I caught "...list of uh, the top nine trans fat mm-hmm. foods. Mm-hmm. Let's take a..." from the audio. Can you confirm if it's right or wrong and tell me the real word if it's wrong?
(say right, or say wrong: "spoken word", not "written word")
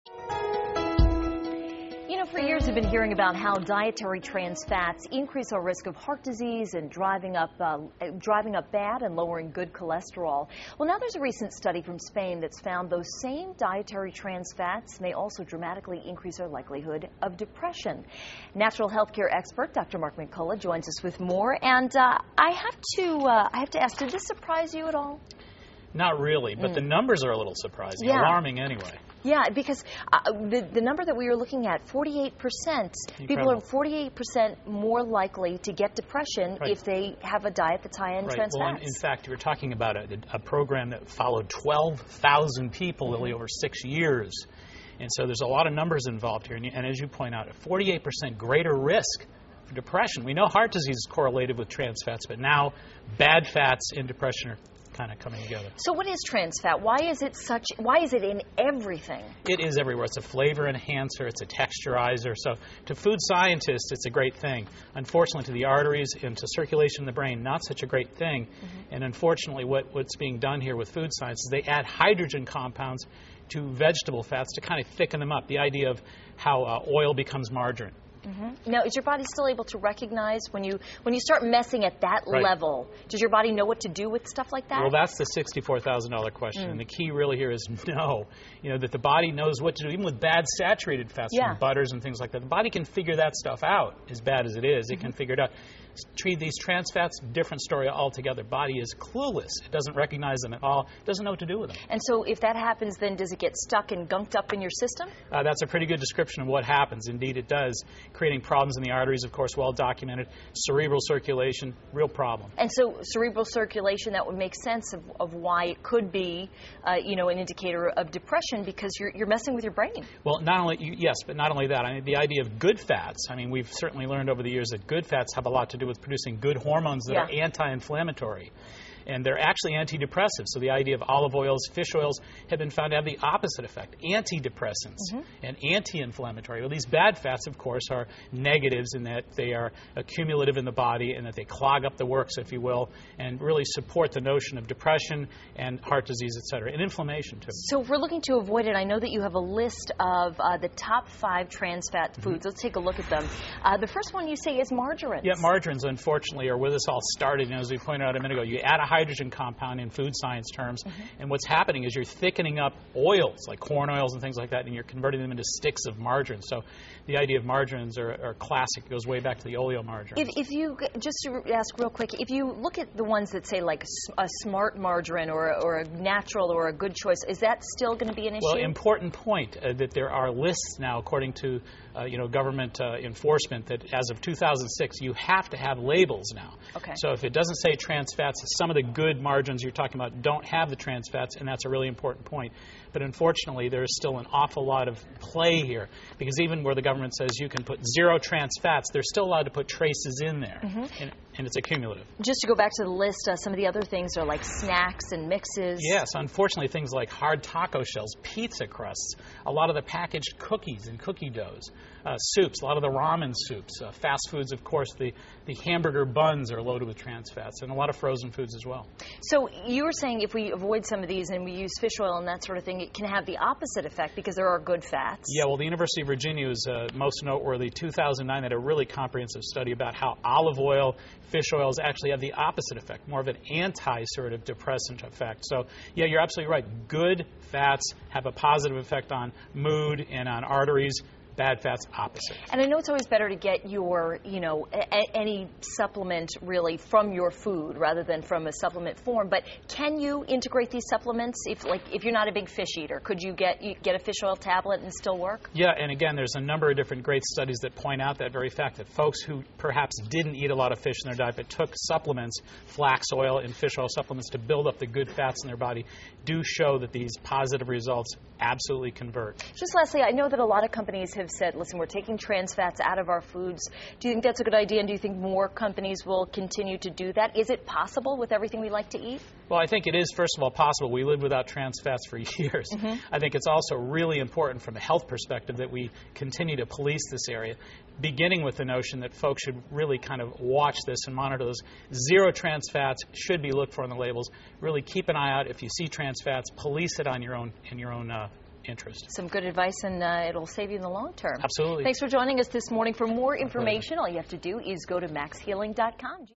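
wrong: "five", not "nine".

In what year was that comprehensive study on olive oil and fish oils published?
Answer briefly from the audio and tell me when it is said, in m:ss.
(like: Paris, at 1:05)
2009, at 3:47.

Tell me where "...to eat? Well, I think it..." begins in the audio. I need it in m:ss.
4:38.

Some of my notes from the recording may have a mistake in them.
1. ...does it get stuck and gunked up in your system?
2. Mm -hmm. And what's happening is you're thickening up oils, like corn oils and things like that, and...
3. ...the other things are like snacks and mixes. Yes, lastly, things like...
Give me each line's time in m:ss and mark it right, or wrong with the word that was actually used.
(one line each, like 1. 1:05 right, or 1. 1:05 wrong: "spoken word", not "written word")
1. 1:43 right
2. 2:40 right
3. 3:23 wrong: "unfortunately", not "lastly".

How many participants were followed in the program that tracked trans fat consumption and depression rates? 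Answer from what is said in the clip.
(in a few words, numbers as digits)
12,000.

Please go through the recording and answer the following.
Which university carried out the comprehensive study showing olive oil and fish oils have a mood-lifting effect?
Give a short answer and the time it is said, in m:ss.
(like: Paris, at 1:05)
University of Virginia, at 3:45.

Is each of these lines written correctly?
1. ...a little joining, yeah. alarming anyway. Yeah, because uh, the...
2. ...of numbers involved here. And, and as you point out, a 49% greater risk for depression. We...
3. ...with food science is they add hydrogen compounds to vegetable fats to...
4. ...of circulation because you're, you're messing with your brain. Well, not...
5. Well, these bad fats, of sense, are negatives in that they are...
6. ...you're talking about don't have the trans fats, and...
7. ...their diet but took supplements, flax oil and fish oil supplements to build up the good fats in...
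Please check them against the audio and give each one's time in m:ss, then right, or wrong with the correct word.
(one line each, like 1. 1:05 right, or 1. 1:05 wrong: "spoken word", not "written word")
1. 0:27 wrong: "surprising", not "joining"
2. 0:45 wrong: "48", not "49"
3. 1:10 right
4. 1:57 wrong: "depression", not "circulation"
5. 2:16 wrong: "course", not "sense"
6. 3:09 right
7. 4:21 right.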